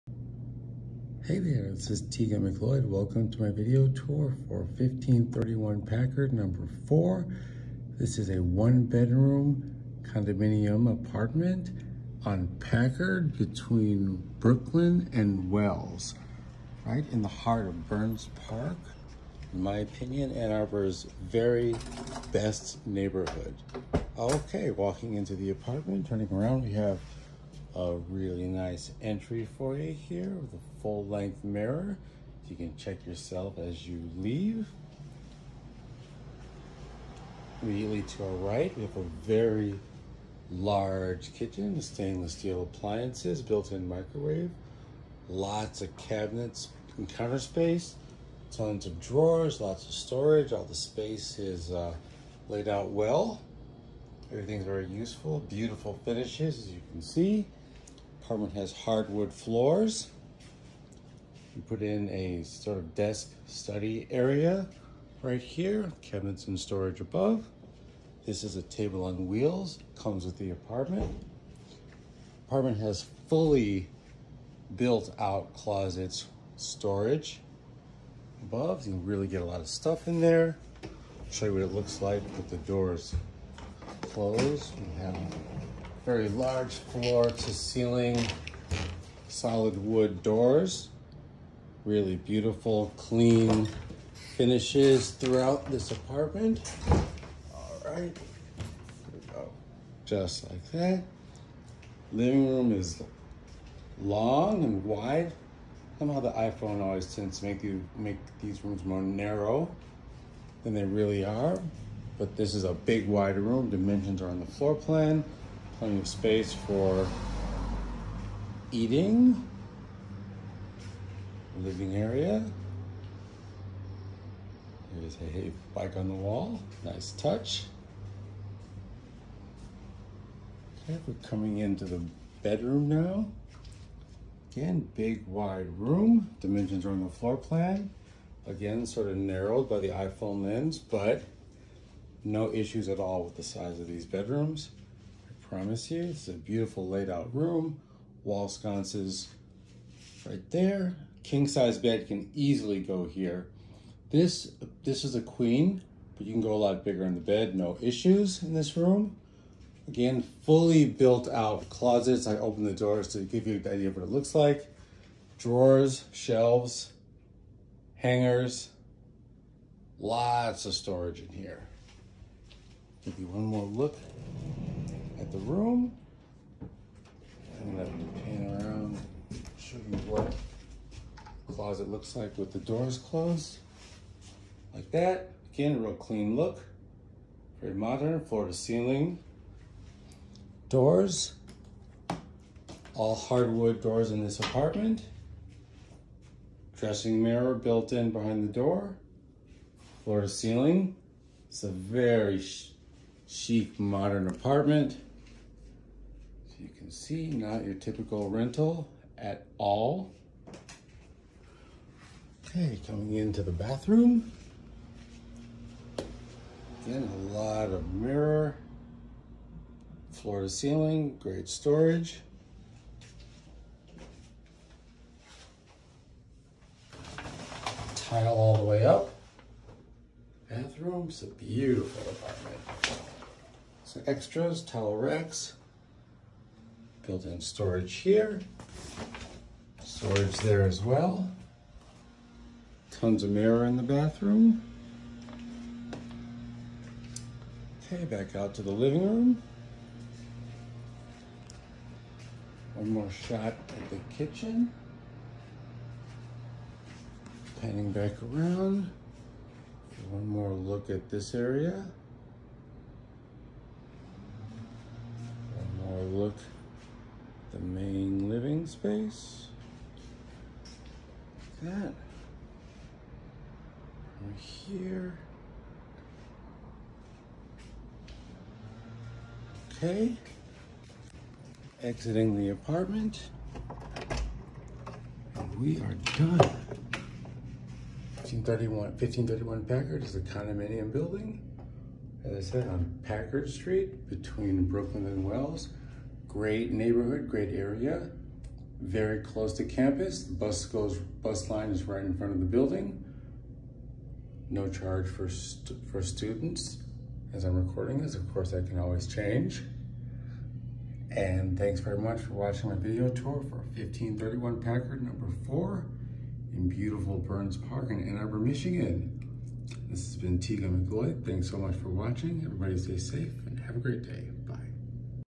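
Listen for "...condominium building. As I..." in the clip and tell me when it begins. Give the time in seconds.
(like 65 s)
290 s.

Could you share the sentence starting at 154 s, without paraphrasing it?
This, this is a queen, but you can go a lot bigger in the bed, no issues in this room.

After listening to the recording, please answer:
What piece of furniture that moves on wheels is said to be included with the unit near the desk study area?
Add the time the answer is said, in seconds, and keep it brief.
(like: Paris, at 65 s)
a table, at 68 s.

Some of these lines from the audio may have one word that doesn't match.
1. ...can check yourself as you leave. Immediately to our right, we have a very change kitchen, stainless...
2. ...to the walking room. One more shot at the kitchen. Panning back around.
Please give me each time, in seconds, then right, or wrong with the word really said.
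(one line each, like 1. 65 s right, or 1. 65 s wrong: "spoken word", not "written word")
1. 32 s wrong: "large", not "change"
2. 248 s wrong: "living", not "walking".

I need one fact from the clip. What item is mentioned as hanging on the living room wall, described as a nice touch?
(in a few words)
a bike.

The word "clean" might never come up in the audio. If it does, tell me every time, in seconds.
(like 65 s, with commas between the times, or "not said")
92 s, 185 s.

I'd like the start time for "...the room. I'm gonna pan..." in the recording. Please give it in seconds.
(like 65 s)
175 s.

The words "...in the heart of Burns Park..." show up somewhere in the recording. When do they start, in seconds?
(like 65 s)
17 s.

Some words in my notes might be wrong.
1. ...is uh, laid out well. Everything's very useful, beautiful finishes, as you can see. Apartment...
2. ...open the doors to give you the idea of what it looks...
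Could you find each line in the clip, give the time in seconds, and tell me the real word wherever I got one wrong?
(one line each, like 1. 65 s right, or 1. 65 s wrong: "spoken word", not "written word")
1. 51 s right
2. 162 s right.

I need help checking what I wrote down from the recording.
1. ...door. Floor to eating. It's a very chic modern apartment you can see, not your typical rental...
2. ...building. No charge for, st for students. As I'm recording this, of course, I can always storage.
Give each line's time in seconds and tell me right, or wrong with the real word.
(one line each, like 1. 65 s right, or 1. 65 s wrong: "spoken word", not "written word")
1. 198 s wrong: "ceiling", not "eating"
2. 302 s wrong: "change", not "storage".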